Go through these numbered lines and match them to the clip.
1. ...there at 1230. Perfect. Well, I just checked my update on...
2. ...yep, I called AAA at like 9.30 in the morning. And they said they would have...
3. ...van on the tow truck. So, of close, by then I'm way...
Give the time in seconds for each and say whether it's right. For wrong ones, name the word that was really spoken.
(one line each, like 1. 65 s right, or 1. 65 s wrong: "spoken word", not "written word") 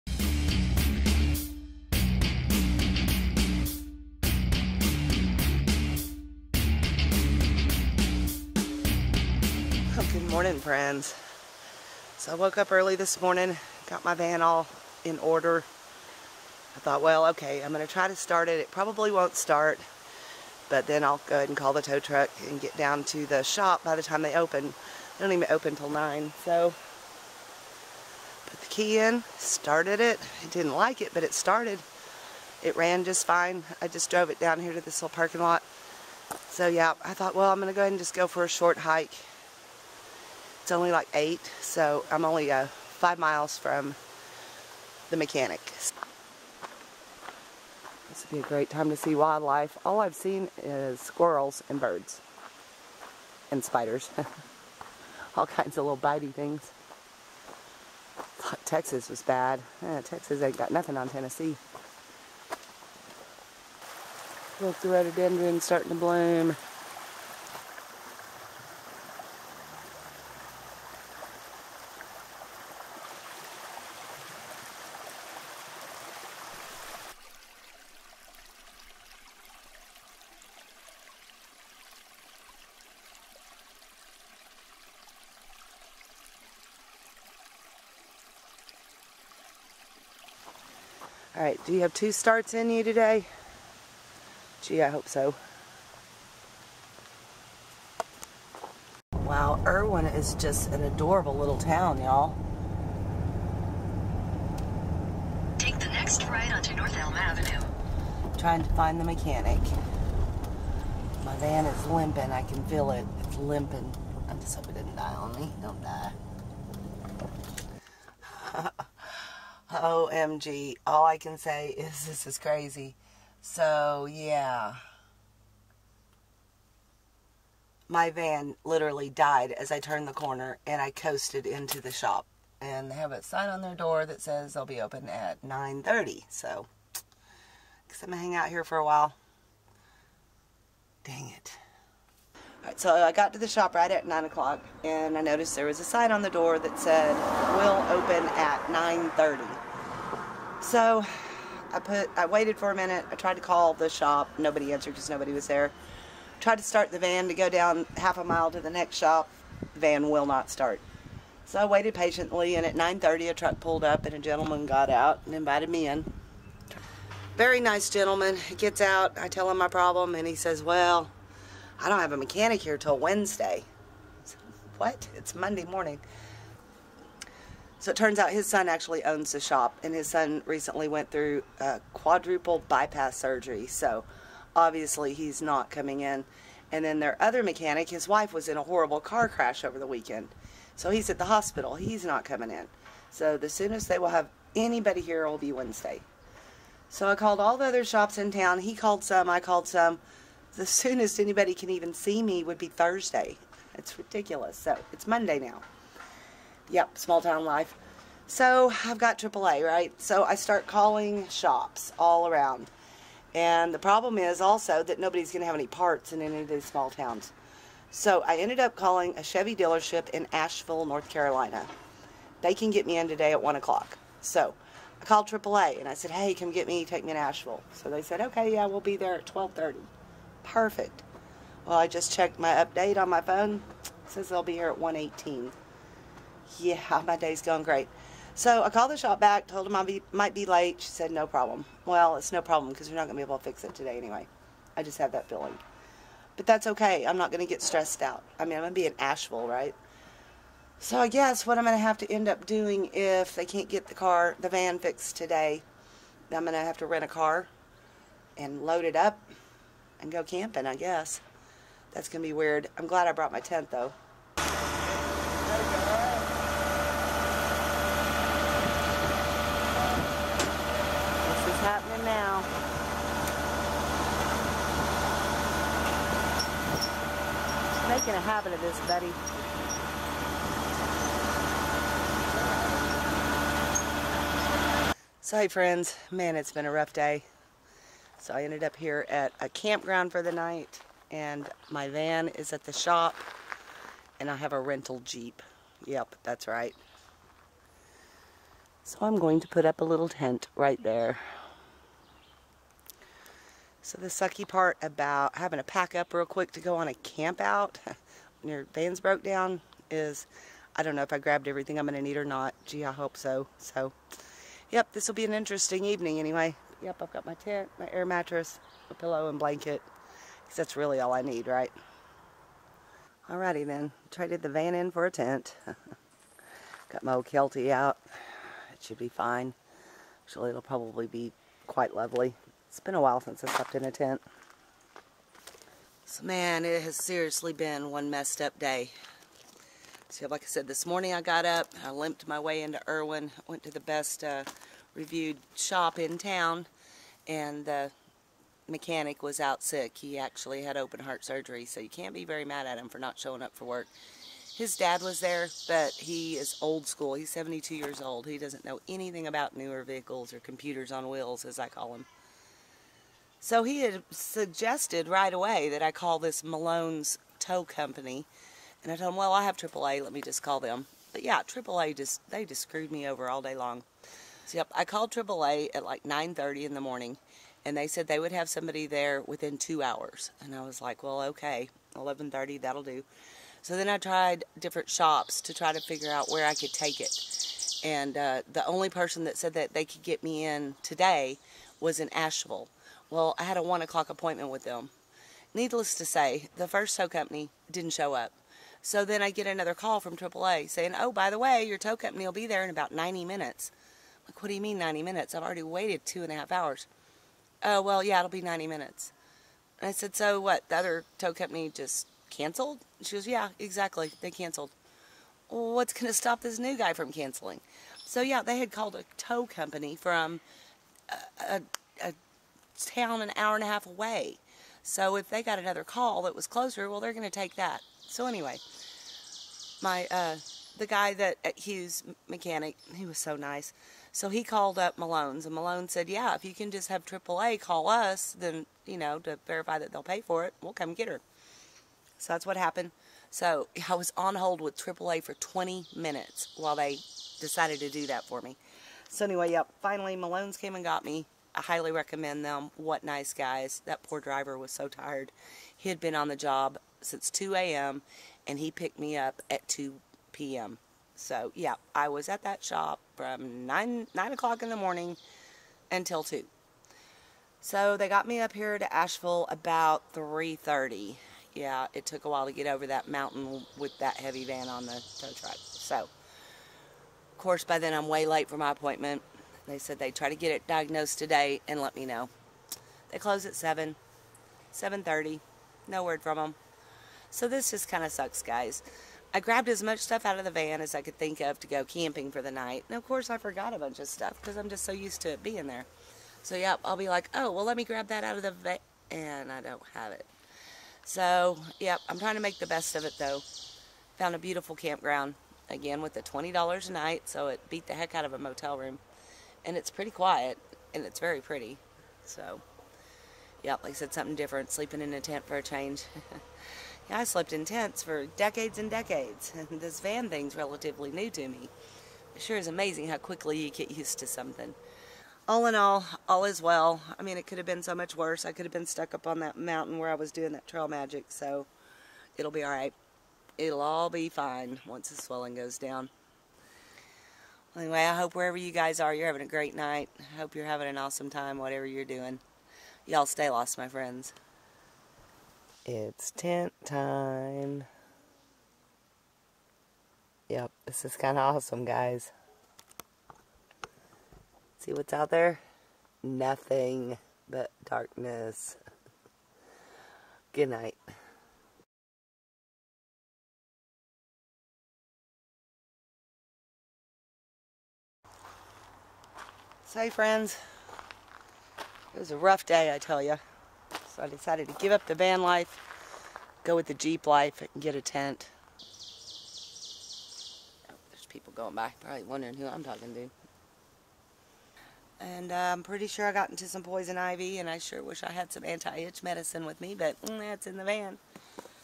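1. 228 s right
2. 374 s right
3. 474 s wrong: "course", not "close".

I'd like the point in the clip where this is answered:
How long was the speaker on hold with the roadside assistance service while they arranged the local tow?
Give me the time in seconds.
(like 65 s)
445 s.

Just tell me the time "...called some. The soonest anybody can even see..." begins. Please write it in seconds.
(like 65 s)
199 s.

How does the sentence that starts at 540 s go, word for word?
I hope you're having an awesome time, whatever you're doing.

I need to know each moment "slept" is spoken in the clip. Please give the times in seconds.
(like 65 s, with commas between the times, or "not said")
333 s, 517 s.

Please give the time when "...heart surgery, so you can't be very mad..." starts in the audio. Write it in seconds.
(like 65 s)
351 s.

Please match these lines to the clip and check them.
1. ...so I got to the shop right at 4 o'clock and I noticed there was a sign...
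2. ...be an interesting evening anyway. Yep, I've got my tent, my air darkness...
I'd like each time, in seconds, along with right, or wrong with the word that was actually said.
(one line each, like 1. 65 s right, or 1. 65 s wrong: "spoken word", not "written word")
1. 142 s wrong: "9", not "4"
2. 315 s wrong: "mattress", not "darkness".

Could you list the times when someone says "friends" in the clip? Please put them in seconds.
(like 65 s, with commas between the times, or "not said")
10 s, 285 s, 543 s, 570 s.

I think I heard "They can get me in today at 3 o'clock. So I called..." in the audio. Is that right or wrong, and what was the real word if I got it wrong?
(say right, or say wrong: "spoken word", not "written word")
wrong: "1", not "3".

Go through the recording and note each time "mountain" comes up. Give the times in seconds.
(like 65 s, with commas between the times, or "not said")
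473 s, 529 s.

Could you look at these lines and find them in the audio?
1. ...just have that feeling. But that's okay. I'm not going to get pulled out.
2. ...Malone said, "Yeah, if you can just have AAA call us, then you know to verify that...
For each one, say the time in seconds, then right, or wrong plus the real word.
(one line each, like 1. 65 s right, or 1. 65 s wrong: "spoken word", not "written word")
1. 244 s wrong: "stressed", not "pulled"
2. 435 s right.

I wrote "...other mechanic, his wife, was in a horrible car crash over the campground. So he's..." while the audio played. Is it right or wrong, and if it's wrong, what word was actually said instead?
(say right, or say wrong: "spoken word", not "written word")
wrong: "weekend", not "campground".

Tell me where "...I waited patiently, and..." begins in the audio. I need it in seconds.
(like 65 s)
161 s.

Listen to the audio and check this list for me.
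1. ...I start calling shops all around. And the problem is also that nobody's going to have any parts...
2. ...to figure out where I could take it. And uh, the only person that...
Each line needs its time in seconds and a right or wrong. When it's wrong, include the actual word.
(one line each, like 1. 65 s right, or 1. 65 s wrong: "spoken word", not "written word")
1. 210 s right
2. 385 s right.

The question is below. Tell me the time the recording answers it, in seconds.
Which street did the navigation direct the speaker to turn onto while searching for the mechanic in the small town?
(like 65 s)
106 s.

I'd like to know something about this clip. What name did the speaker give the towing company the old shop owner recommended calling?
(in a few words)
Malone's Tow Company.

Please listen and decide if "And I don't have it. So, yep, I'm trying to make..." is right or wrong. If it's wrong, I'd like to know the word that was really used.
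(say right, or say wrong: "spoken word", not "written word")
right.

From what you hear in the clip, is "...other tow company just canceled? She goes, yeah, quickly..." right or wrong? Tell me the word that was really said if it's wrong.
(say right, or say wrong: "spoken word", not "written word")
wrong: "exactly", not "quickly".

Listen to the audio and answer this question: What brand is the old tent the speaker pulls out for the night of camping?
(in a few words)
Kelty.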